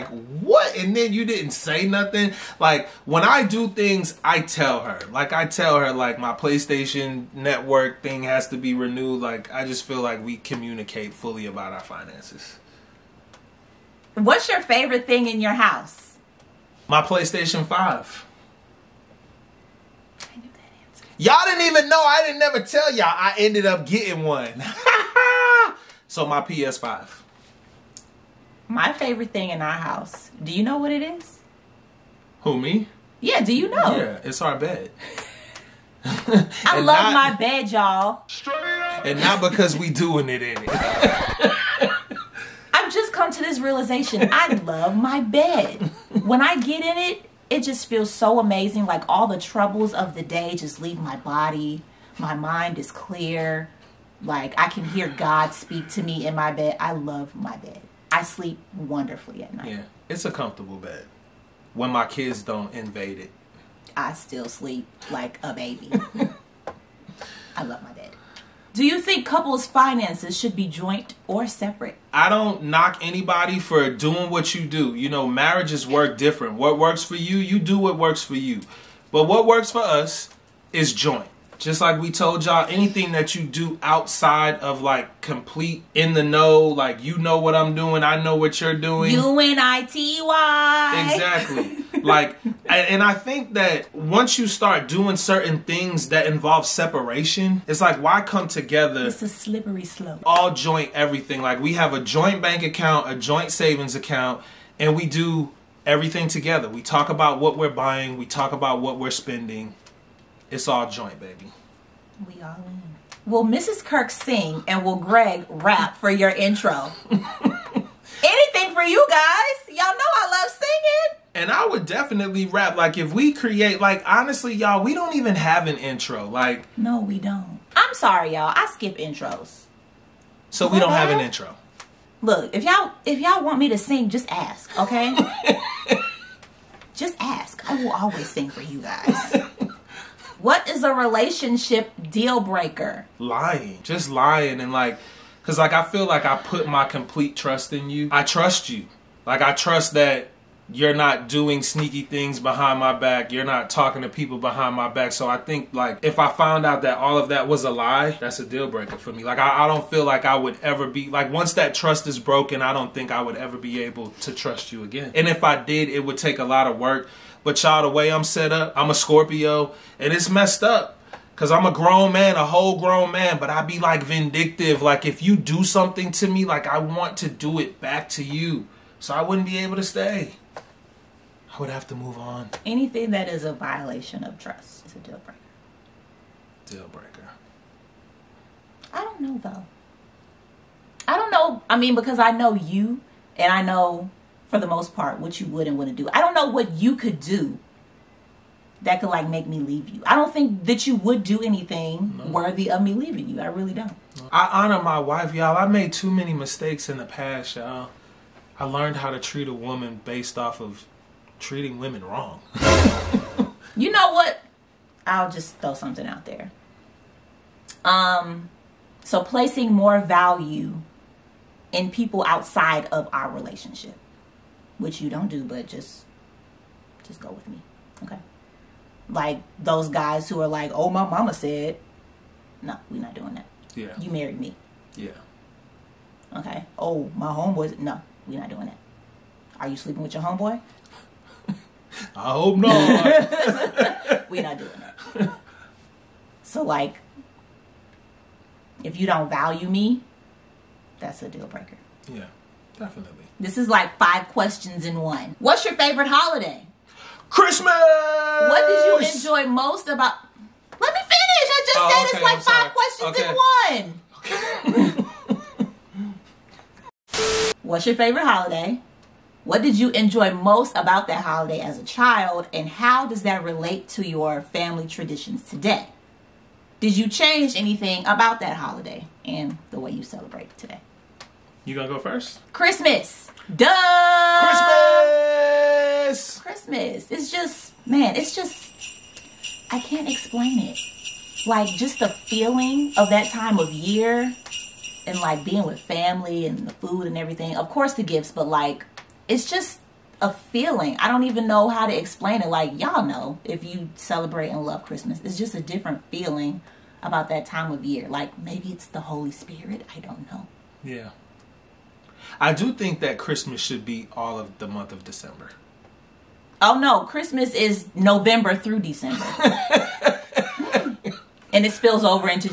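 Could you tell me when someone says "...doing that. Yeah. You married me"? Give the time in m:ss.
3:53.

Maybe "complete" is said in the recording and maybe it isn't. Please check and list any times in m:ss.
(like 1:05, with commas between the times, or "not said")
1:25, 2:26.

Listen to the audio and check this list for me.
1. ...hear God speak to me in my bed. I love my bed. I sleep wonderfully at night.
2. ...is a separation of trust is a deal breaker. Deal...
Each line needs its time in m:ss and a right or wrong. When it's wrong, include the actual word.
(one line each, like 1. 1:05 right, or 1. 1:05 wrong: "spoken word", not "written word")
1. 0:54 right
2. 3:03 wrong: "violation", not "separation".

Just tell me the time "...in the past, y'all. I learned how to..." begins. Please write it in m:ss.
3:26.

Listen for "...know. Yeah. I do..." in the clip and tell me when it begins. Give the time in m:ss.
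5:10.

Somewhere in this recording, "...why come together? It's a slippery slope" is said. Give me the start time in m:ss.
1:37.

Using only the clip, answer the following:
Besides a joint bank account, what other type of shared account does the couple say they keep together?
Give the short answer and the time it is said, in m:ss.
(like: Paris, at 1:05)
Joint savings account, at 1:43.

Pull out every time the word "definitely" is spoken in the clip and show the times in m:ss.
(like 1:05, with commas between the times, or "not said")
2:01, 4:12.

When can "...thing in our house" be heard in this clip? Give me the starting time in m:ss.
0:29.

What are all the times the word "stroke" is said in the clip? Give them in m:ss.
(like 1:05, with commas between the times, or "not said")
not said.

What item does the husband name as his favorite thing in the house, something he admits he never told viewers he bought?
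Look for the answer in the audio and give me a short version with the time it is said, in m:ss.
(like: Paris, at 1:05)
PlayStation 5, at 0:16.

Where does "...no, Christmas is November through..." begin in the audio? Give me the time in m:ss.
5:16.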